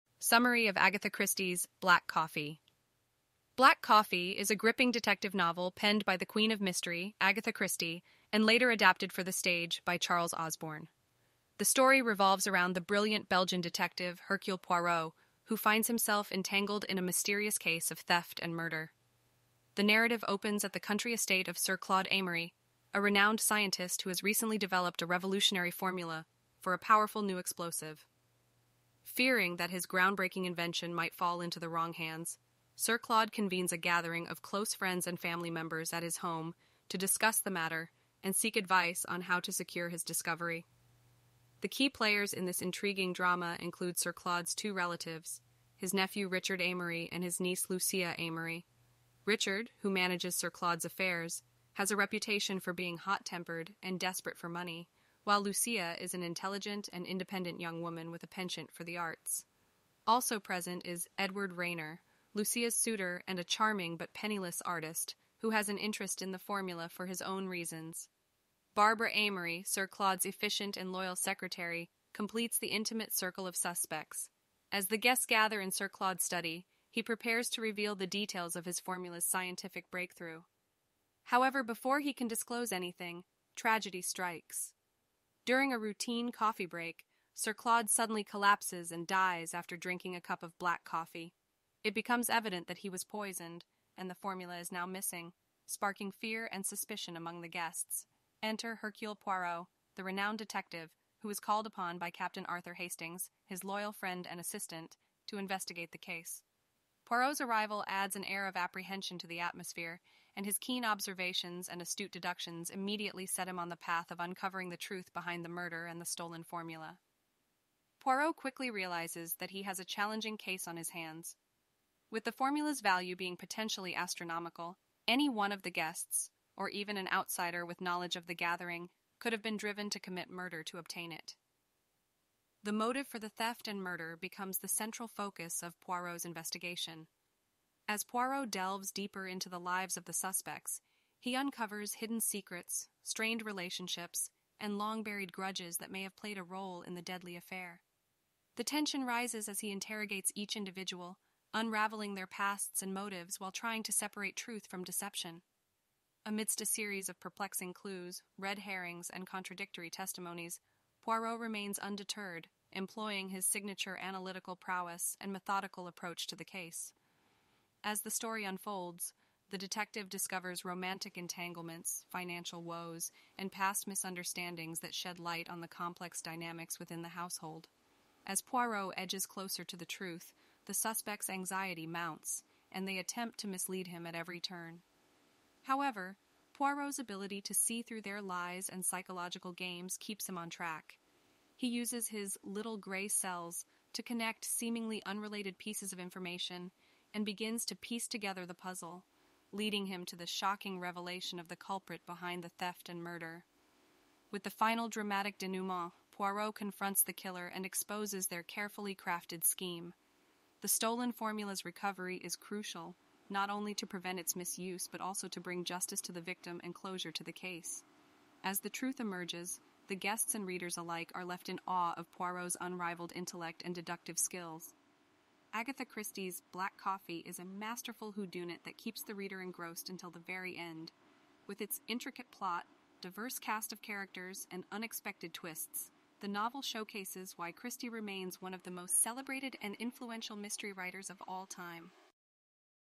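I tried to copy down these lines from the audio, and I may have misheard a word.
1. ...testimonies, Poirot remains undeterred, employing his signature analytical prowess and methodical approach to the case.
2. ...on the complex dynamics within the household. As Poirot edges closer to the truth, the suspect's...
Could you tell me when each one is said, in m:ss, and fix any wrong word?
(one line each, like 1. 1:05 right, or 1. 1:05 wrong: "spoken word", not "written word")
1. 2:39 right
2. 2:55 right.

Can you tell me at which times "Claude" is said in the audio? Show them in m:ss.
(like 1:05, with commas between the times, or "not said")
0:21, 0:32, 0:44, 0:50, 1:09, 1:15, 1:27.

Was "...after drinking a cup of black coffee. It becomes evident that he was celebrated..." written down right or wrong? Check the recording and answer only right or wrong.
wrong.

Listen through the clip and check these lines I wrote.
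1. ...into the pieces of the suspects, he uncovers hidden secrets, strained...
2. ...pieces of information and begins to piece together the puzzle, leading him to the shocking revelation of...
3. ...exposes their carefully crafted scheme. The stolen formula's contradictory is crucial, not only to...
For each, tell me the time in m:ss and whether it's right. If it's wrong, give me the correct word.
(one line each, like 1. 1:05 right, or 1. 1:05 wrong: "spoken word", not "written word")
1. 2:19 wrong: "lives", not "pieces"
2. 3:15 right
3. 3:27 wrong: "recovery", not "contradictory".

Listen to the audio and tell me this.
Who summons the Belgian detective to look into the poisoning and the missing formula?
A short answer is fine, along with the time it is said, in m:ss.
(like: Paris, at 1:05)
Captain Arthur Hastings, at 1:42.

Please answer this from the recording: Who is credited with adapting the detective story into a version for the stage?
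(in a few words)
Charles Osborne.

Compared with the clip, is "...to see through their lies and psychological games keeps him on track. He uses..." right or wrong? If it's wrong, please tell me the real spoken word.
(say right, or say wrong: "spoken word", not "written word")
right.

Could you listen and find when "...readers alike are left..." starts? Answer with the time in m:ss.
3:40.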